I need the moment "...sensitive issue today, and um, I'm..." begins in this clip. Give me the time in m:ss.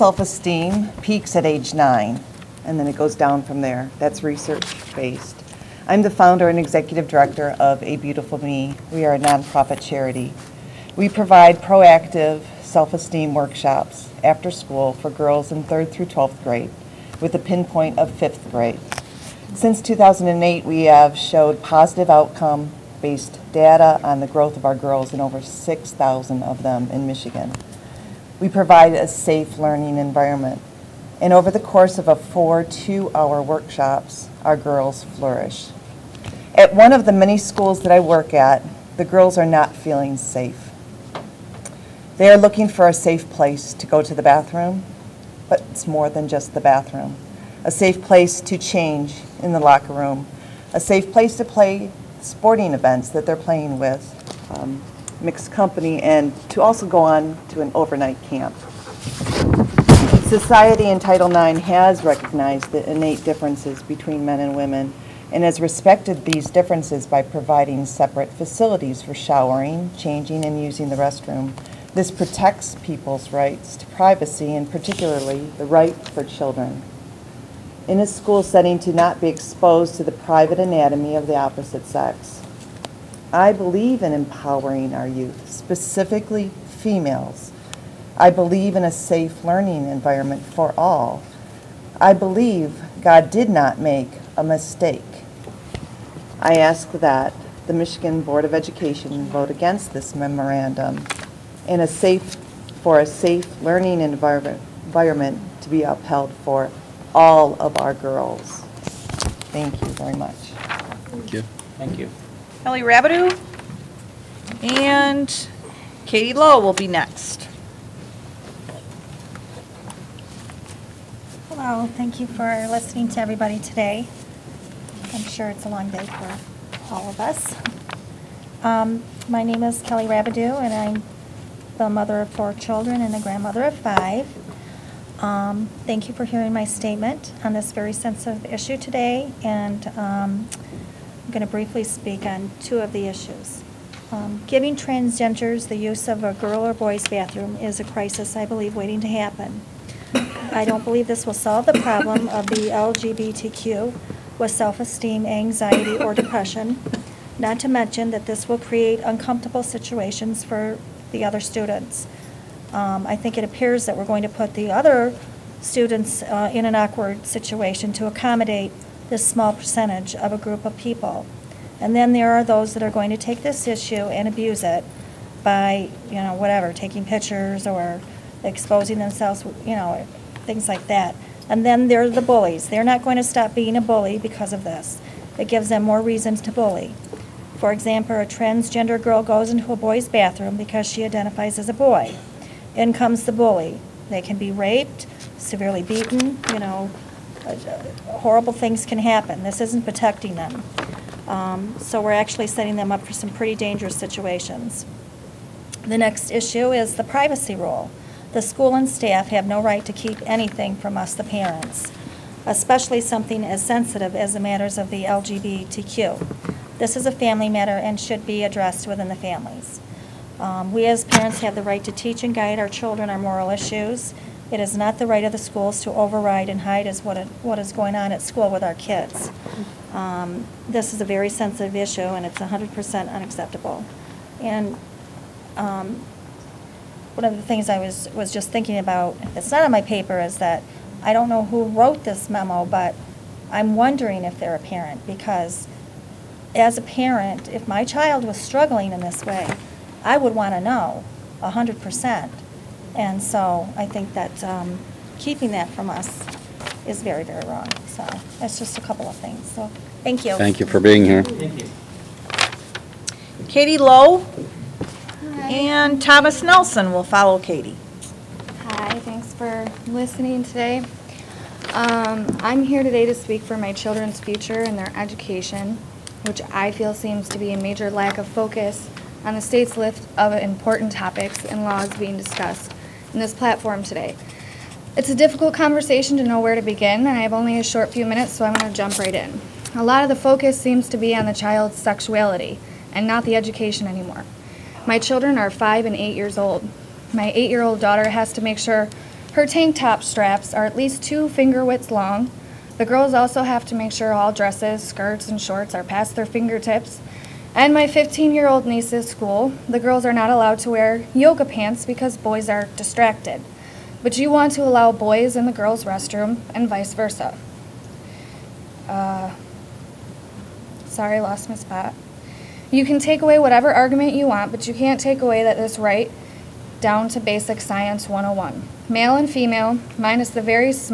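2:17.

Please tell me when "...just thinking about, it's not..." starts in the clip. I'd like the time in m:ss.
3:58.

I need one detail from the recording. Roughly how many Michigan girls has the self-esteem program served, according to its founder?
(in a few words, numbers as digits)
6,000.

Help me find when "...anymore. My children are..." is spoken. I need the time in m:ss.
4:53.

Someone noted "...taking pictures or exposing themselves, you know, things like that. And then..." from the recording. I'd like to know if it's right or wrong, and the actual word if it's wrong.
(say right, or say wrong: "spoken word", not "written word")
right.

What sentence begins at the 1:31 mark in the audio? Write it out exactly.
I believe God did not make a mistake.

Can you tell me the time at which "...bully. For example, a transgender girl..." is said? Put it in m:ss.
3:06.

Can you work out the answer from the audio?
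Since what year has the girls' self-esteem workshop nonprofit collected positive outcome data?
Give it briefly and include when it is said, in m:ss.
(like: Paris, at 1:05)
2008, at 0:19.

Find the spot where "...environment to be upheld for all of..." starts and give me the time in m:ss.
1:44.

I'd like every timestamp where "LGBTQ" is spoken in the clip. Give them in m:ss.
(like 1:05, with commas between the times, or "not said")
2:32, 3:35.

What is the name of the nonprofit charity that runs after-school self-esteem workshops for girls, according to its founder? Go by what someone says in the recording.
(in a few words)
A Beautiful Me.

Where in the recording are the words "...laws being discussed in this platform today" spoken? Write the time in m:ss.
4:41.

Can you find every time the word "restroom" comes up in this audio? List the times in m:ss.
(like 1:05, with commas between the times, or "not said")
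1:10, 5:15.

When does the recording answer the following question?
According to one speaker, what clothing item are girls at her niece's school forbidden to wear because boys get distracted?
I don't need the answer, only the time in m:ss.
5:11.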